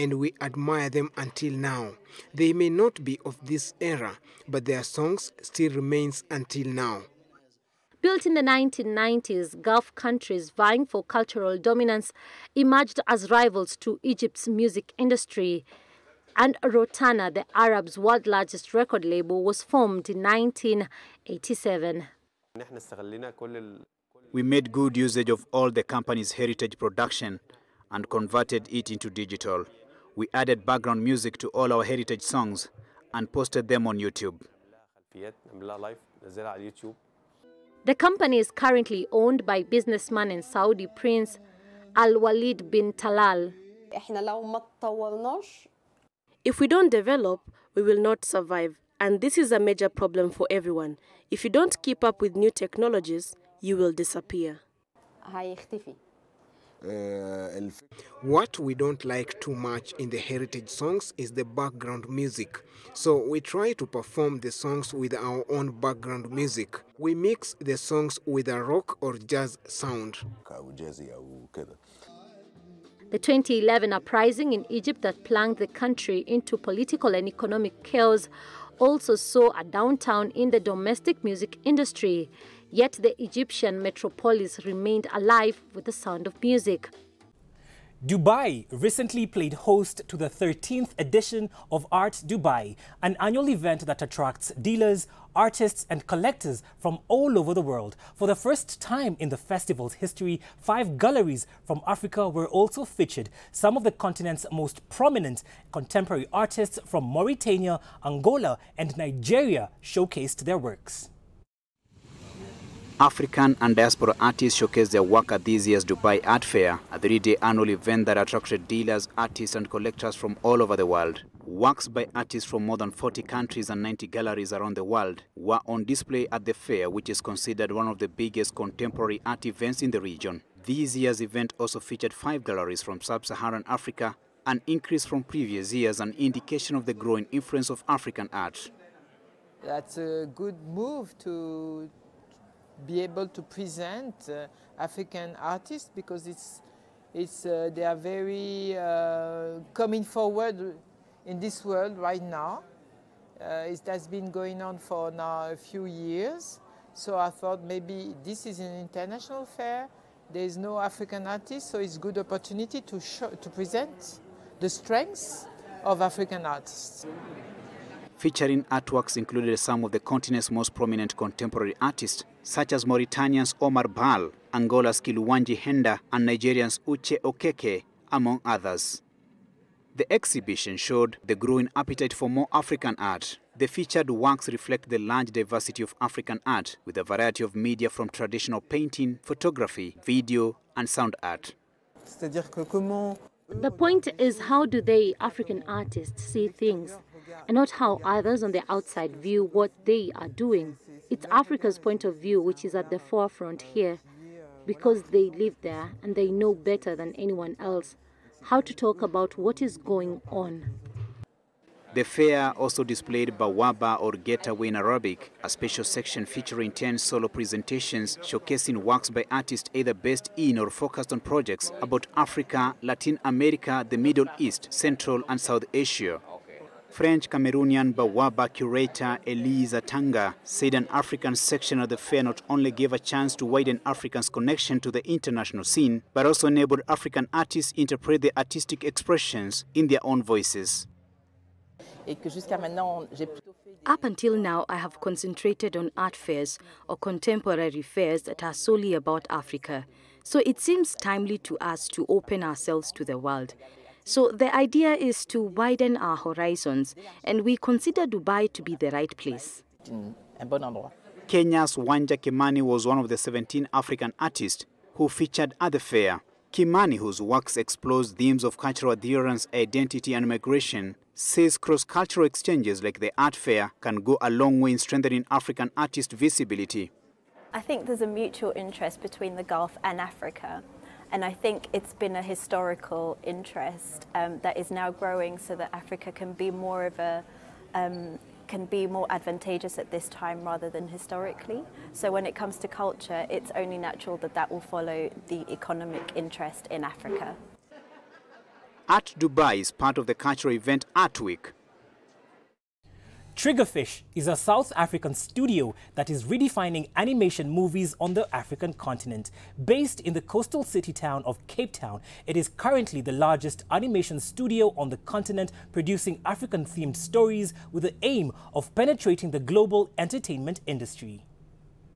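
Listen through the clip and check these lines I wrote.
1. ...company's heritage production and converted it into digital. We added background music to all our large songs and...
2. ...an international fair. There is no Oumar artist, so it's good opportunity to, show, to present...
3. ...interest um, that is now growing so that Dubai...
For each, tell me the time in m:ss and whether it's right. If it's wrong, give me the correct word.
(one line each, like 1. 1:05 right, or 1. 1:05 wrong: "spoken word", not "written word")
1. 0:25 wrong: "heritage", not "large"
2. 2:38 wrong: "African", not "Oumar"
3. 4:43 wrong: "Africa", not "Dubai".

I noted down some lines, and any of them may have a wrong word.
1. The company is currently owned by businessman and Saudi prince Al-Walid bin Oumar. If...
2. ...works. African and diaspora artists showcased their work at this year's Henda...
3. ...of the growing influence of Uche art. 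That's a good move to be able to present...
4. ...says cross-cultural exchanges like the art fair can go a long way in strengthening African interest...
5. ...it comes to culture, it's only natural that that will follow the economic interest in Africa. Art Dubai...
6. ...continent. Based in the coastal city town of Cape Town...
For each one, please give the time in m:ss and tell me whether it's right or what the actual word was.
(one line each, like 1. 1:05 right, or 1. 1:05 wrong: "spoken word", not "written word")
1. 0:37 wrong: "Talal", not "Oumar"
2. 1:50 wrong: "Dubai", not "Henda"
3. 2:16 wrong: "African", not "Uche"
4. 4:31 wrong: "artist", not "interest"
5. 4:52 right
6. 5:08 right.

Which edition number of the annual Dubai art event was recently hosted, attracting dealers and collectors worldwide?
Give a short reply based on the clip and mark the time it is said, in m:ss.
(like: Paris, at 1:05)
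13th, at 1:30.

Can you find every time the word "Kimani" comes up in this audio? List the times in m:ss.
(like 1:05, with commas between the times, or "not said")
4:22, 4:26.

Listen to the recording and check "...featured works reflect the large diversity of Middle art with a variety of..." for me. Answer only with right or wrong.
wrong.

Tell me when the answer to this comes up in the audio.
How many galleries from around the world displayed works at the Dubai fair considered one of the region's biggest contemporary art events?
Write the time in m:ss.
2:03.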